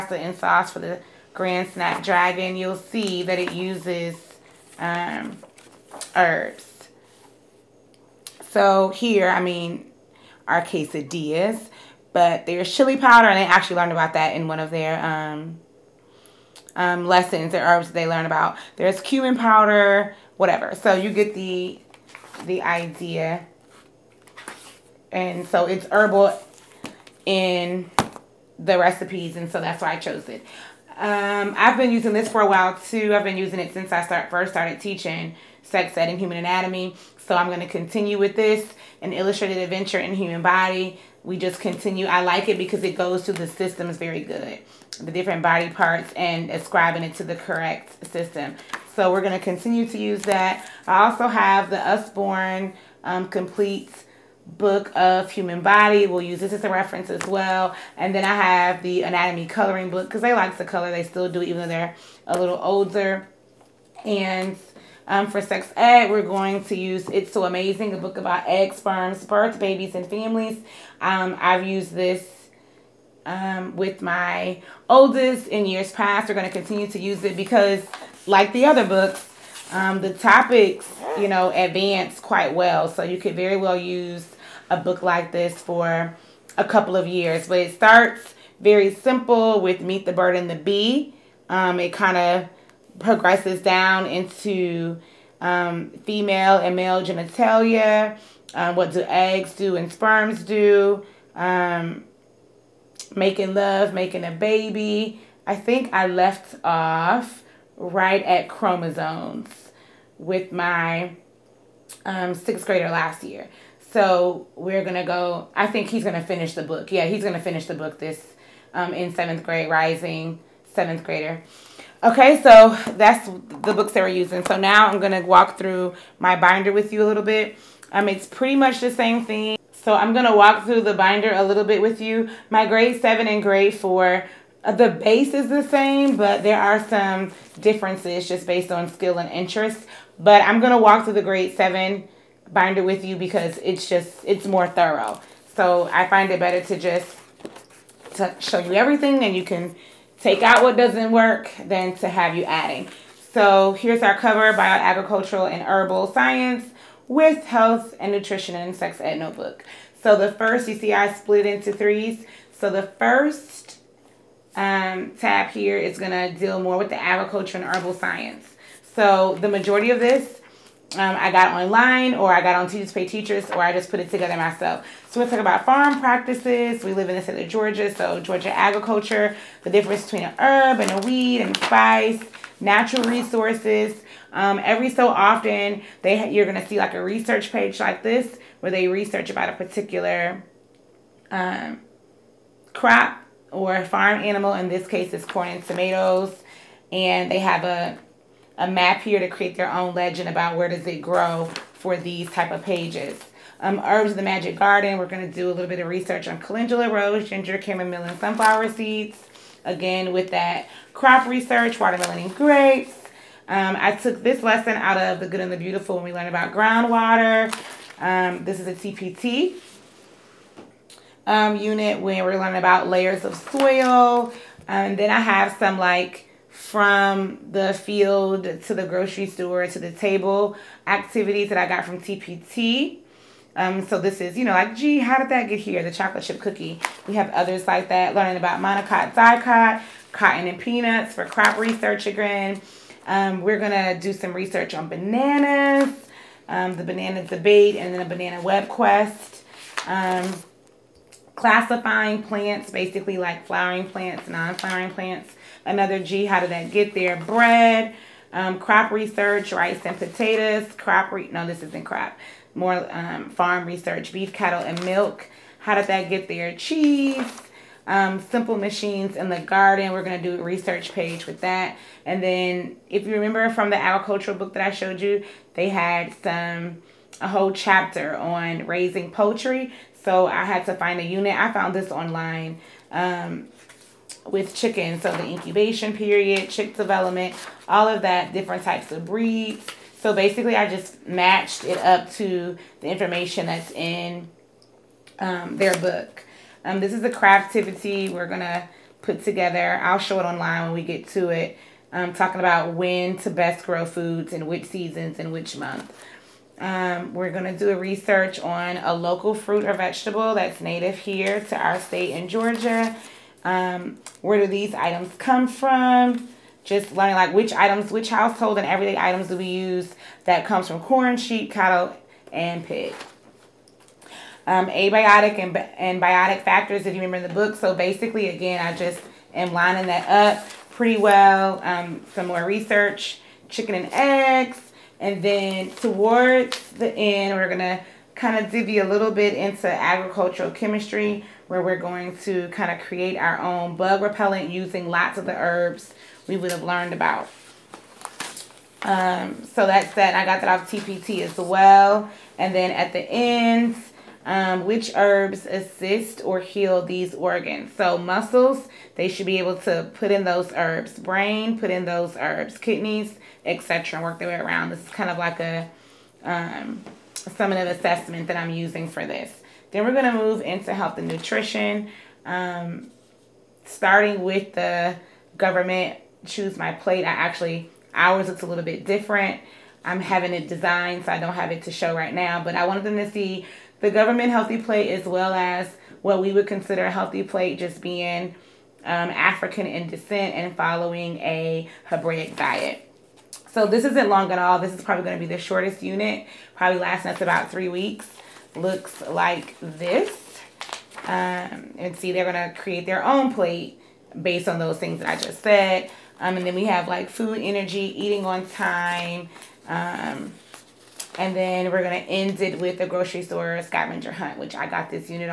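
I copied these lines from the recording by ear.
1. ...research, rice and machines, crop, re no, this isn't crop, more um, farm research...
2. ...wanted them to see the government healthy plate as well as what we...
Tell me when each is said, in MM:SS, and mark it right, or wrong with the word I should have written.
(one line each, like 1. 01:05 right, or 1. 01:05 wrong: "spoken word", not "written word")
1. 04:18 wrong: "potatoes", not "machines"
2. 06:22 right.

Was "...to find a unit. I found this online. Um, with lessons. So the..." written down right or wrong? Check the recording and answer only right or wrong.
wrong.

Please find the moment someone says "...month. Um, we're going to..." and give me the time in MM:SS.
05:05.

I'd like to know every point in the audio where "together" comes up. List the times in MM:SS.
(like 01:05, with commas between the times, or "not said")
02:54, 04:59.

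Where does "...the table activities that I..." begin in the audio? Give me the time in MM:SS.
03:49.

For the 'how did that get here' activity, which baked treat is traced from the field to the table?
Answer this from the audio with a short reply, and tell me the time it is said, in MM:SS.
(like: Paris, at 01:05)
chocolate chip cookie, at 03:55.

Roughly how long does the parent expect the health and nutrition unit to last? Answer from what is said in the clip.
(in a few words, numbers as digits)
3 weeks.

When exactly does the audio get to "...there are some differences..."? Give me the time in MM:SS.
02:16.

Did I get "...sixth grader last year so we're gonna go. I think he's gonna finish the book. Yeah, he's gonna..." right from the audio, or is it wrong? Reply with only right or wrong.
right.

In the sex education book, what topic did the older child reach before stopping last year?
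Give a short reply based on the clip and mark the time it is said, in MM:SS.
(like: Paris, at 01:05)
chromosomes, at 01:48.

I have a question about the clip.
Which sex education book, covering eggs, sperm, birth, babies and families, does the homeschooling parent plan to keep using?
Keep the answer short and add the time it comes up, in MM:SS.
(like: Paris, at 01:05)
It's So Amazing, at 01:07.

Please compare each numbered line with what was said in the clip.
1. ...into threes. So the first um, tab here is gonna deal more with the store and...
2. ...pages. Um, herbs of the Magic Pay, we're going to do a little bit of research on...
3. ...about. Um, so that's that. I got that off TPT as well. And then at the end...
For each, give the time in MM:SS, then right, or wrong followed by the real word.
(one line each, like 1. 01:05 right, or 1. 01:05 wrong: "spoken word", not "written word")
1. 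02:41 wrong: "agriculture", not "store"
2. 03:22 wrong: "Garden", not "Pay"
3. 05:46 right.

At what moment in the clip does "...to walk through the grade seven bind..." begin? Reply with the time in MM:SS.
02:20.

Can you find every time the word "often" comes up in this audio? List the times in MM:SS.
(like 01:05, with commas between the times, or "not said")
03:05.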